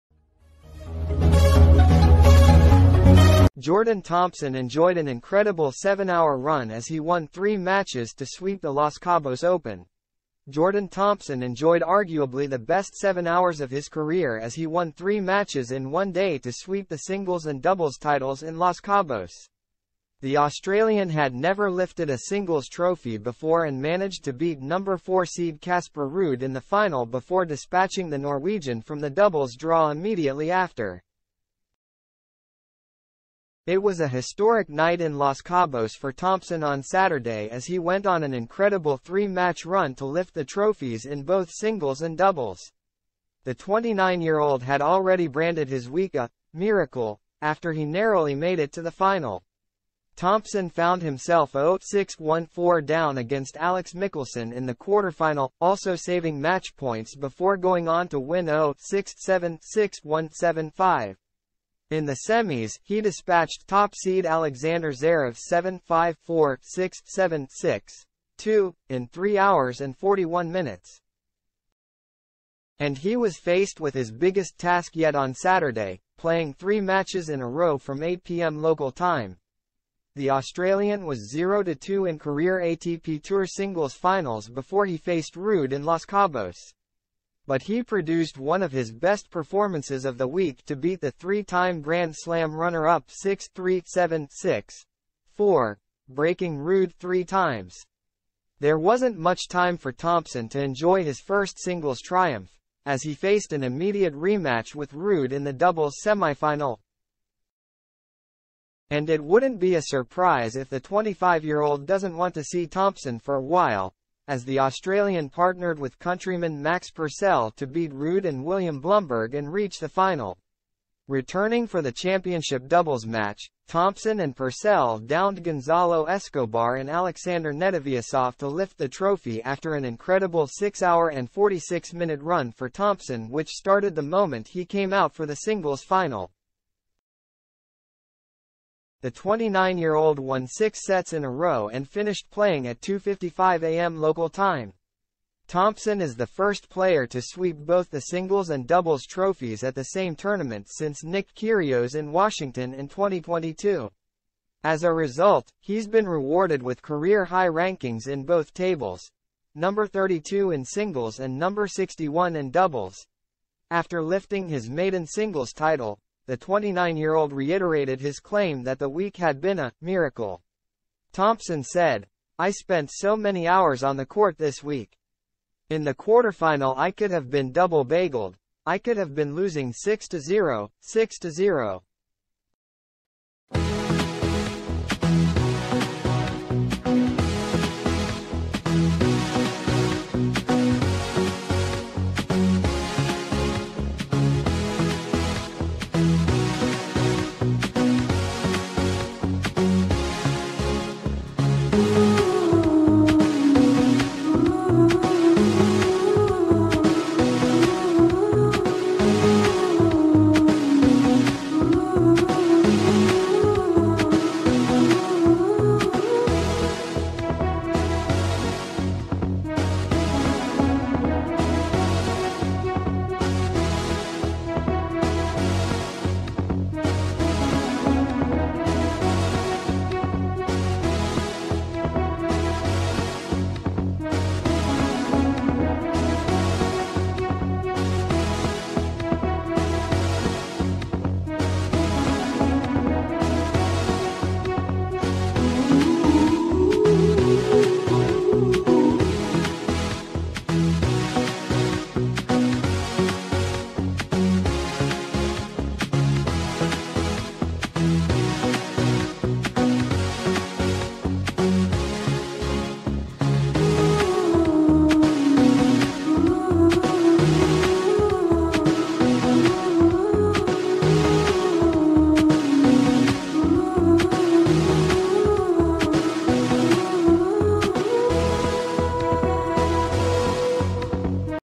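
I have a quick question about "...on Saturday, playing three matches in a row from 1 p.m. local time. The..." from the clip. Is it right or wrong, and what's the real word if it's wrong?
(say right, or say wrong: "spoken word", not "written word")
wrong: "8", not "1".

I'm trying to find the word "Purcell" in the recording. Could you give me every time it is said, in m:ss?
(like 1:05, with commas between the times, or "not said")
1:56, 2:04.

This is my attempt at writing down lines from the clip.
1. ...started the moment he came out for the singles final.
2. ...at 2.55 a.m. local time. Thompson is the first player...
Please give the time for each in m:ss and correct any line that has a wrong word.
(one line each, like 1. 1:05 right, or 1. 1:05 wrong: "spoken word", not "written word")
1. 2:13 right
2. 2:22 right.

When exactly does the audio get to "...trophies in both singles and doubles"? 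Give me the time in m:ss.
0:40.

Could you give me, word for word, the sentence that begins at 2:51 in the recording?
Thompson said, I spent so many hours on the court this week.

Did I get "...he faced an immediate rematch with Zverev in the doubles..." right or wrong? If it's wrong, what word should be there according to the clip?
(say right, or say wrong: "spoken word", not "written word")
wrong: "Ruud", not "Zverev".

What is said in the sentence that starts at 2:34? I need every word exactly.
As a result, he's been rewarded with career-high rankings in both tables, number 32 in singles and number 61 in doubles.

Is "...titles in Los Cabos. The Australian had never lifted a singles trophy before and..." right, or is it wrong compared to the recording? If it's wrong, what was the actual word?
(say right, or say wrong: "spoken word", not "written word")
right.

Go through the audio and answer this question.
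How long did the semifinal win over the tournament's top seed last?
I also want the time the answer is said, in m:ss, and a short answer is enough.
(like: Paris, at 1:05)
3 hours and 41 minutes, at 1:09.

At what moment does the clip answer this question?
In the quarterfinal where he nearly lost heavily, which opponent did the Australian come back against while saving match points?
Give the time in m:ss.
0:53.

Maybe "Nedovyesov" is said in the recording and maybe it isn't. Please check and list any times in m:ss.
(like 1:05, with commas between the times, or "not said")
2:07.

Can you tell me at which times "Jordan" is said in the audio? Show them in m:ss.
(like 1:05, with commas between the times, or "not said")
0:03, 0:10.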